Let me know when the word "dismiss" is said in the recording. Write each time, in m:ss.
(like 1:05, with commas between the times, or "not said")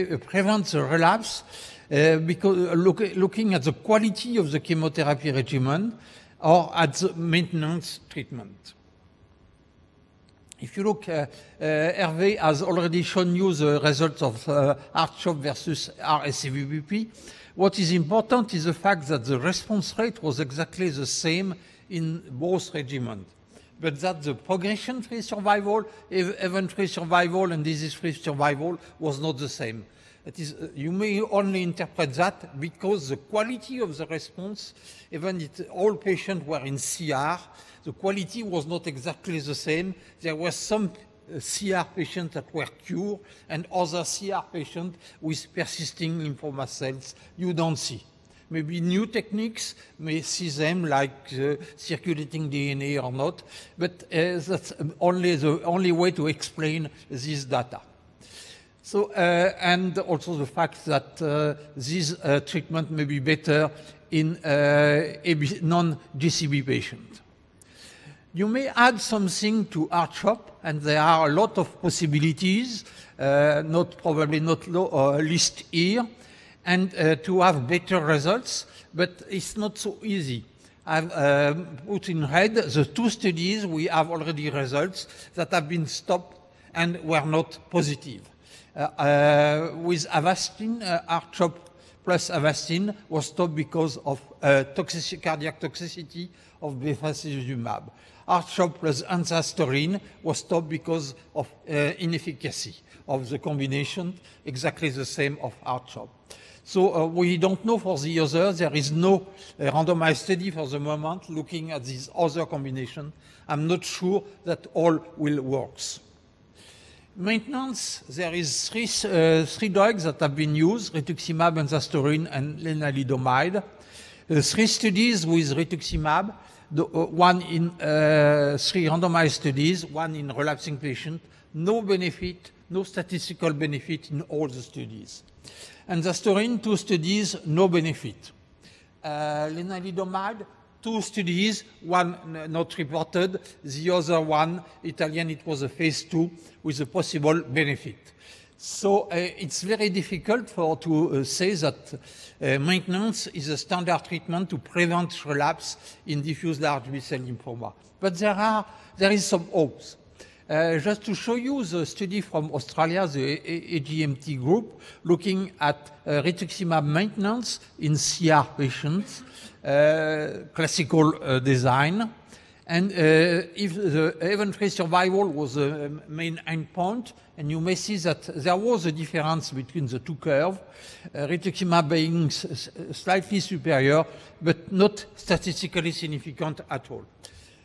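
not said.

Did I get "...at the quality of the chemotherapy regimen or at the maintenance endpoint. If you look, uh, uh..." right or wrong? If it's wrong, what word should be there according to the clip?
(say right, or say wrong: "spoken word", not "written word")
wrong: "treatment", not "endpoint".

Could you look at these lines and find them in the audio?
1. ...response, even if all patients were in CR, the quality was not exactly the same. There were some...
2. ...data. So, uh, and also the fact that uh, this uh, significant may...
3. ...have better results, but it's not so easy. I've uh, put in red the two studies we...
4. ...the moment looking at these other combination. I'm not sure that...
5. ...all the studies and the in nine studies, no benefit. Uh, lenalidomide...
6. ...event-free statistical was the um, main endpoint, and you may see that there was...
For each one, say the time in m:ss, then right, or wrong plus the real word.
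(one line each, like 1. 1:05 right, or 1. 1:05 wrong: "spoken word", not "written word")
1. 0:34 right
2. 0:57 wrong: "treatment", not "significant"
3. 1:17 right
4. 1:50 right
5. 2:14 wrong: "two", not "nine"
6. 2:54 wrong: "survival", not "statistical".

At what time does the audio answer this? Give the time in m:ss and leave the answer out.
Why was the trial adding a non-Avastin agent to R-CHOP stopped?
1:41.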